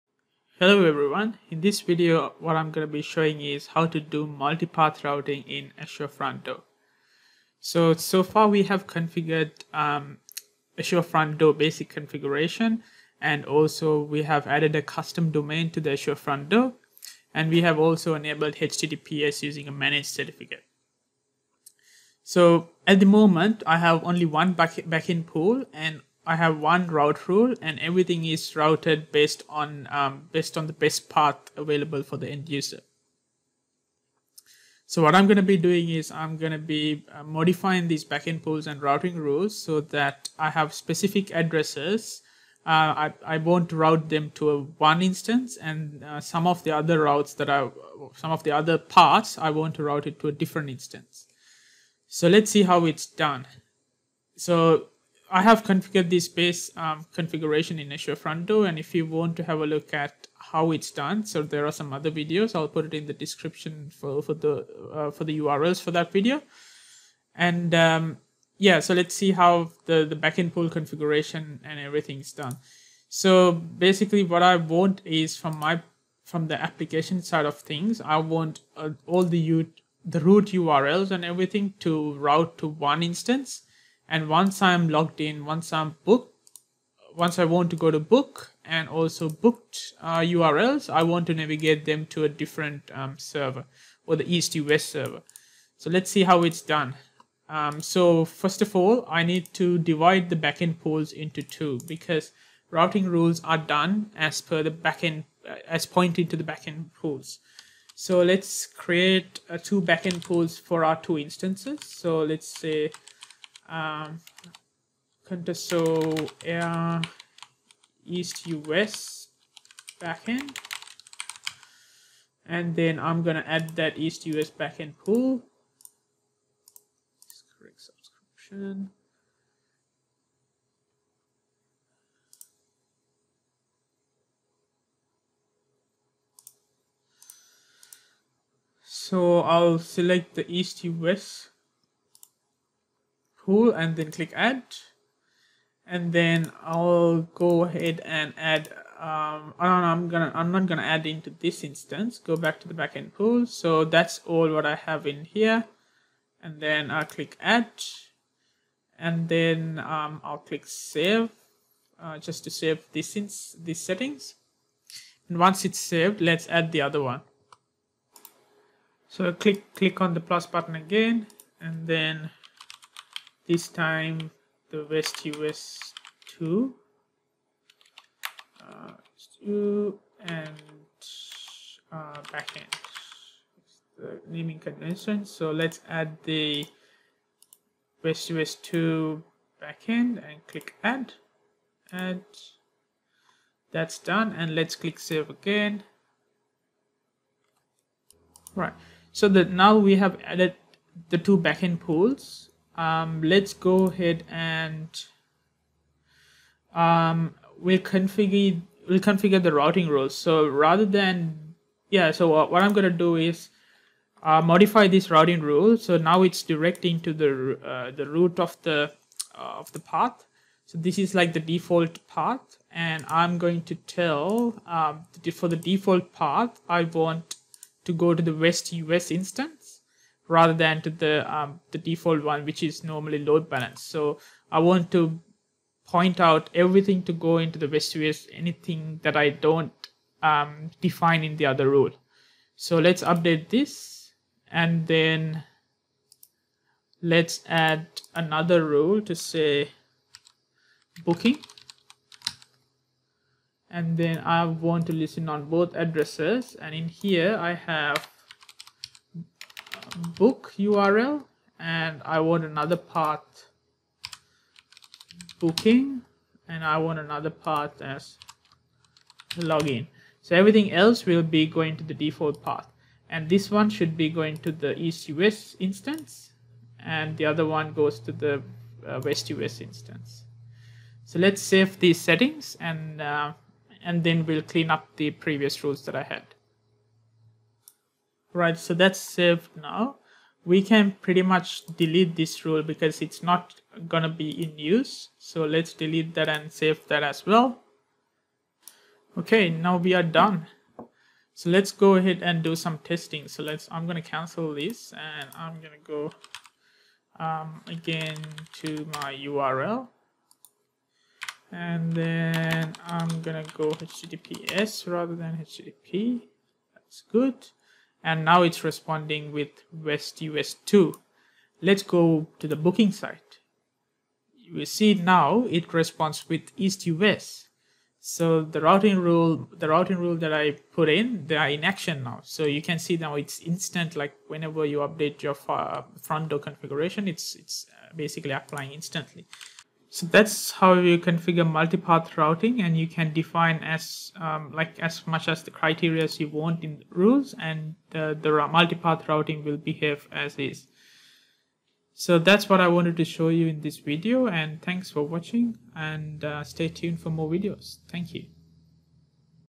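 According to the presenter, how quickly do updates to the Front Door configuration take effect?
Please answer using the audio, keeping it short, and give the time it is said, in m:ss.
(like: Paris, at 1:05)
Instantly, at 5:38.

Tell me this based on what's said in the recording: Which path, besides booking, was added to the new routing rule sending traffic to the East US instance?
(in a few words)
Login.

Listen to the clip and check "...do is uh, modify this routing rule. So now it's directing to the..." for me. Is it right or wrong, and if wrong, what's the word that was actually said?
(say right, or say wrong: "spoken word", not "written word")
right.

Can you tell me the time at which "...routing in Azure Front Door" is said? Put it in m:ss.
0:05.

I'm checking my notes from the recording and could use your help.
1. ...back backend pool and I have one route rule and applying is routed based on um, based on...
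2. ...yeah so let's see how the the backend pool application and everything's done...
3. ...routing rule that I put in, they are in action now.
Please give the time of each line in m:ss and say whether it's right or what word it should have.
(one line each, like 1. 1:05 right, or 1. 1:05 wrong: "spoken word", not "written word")
1. 0:24 wrong: "everything", not "applying"
2. 1:08 wrong: "configuration", not "application"
3. 5:29 right.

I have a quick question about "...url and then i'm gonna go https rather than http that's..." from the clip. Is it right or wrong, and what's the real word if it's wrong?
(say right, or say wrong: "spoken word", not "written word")
right.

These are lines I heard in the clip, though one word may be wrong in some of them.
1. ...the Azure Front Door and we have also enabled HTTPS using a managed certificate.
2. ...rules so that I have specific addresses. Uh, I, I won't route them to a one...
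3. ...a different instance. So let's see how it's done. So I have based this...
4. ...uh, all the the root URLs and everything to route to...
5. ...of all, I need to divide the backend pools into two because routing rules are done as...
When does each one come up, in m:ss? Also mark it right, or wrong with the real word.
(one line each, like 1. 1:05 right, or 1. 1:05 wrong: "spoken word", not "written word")
1. 0:15 right
2. 0:39 right
3. 0:50 wrong: "configured", not "based"
4. 1:18 right
5. 1:38 right.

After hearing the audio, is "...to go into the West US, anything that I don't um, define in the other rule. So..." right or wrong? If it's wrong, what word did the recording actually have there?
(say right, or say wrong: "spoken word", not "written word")
right.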